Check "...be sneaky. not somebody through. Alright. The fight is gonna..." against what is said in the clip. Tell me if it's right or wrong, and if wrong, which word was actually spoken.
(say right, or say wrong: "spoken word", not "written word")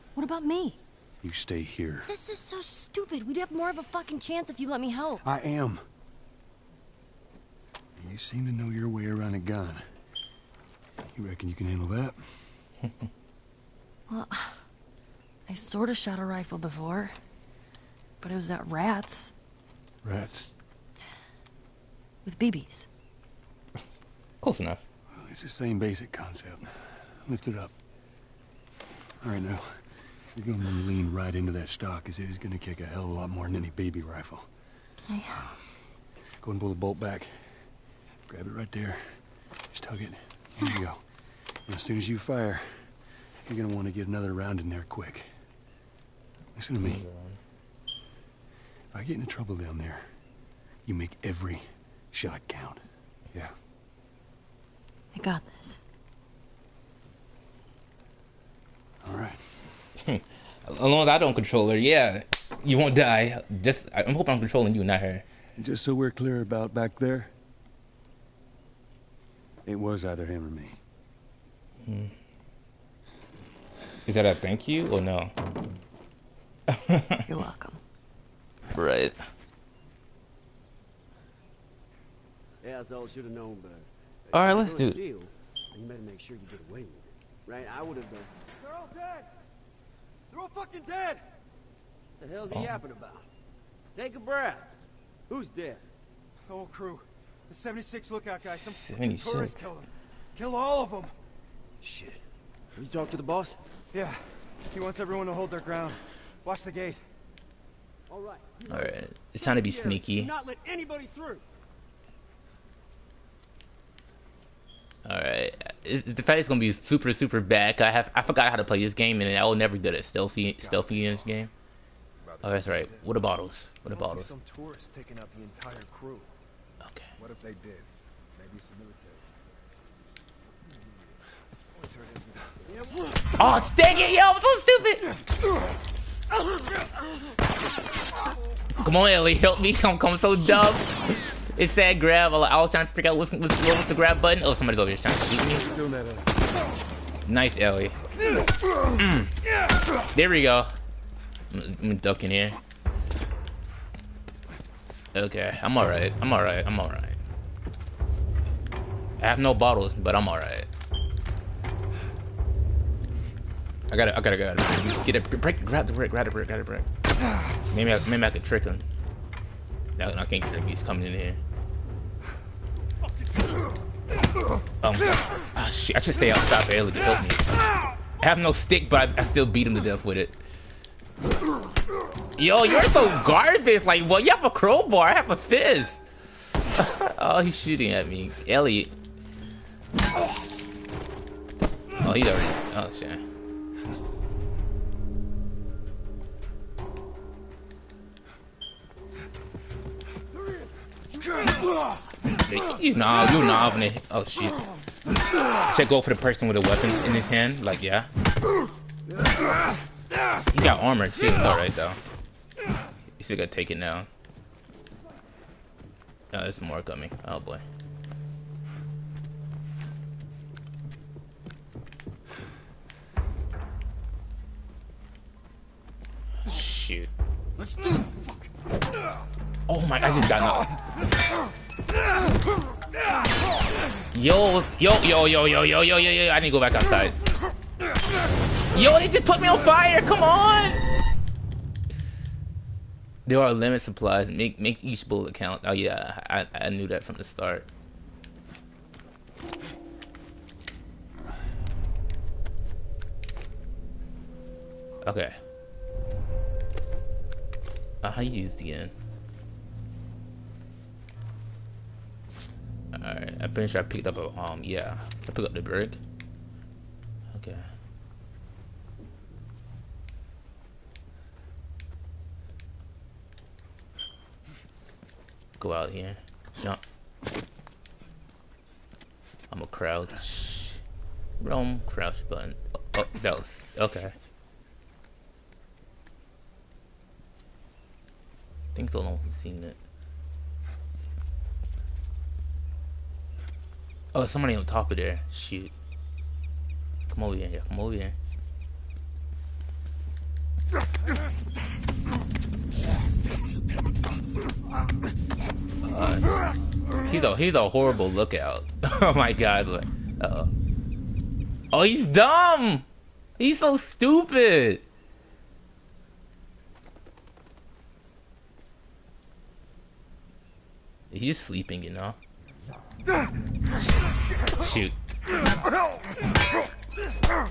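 wrong: "anybody", not "somebody".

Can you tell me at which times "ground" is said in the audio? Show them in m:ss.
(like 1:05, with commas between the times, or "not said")
1:45.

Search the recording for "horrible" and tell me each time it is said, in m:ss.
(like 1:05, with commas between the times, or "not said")
5:07.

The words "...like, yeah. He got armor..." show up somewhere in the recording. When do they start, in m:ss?
3:27.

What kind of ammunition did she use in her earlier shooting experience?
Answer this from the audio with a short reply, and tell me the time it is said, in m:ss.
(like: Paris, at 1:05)
BBs, at 0:22.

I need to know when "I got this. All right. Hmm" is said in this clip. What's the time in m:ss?
0:55.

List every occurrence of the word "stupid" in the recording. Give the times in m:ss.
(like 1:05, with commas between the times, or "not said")
0:02, 2:15, 5:13.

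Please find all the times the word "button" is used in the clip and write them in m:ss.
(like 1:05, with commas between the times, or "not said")
2:24, 4:42.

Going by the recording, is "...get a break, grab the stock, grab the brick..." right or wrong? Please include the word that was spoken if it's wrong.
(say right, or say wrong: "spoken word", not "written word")
wrong: "brick", not "stock".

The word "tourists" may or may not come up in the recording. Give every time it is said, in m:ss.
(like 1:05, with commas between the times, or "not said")
1:39, 2:04.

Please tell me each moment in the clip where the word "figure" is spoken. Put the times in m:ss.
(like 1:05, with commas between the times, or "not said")
2:22.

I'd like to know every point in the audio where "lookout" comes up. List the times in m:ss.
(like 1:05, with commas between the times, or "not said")
1:38, 5:08.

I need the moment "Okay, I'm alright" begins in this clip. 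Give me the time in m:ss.
2:35.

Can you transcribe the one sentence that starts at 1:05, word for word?
Just so we're clear about back there, it was either him or me.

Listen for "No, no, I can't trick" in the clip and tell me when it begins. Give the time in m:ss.
2:49.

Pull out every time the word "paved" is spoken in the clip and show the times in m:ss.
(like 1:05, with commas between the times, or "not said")
not said.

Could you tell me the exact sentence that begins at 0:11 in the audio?
You reckon you can handle that?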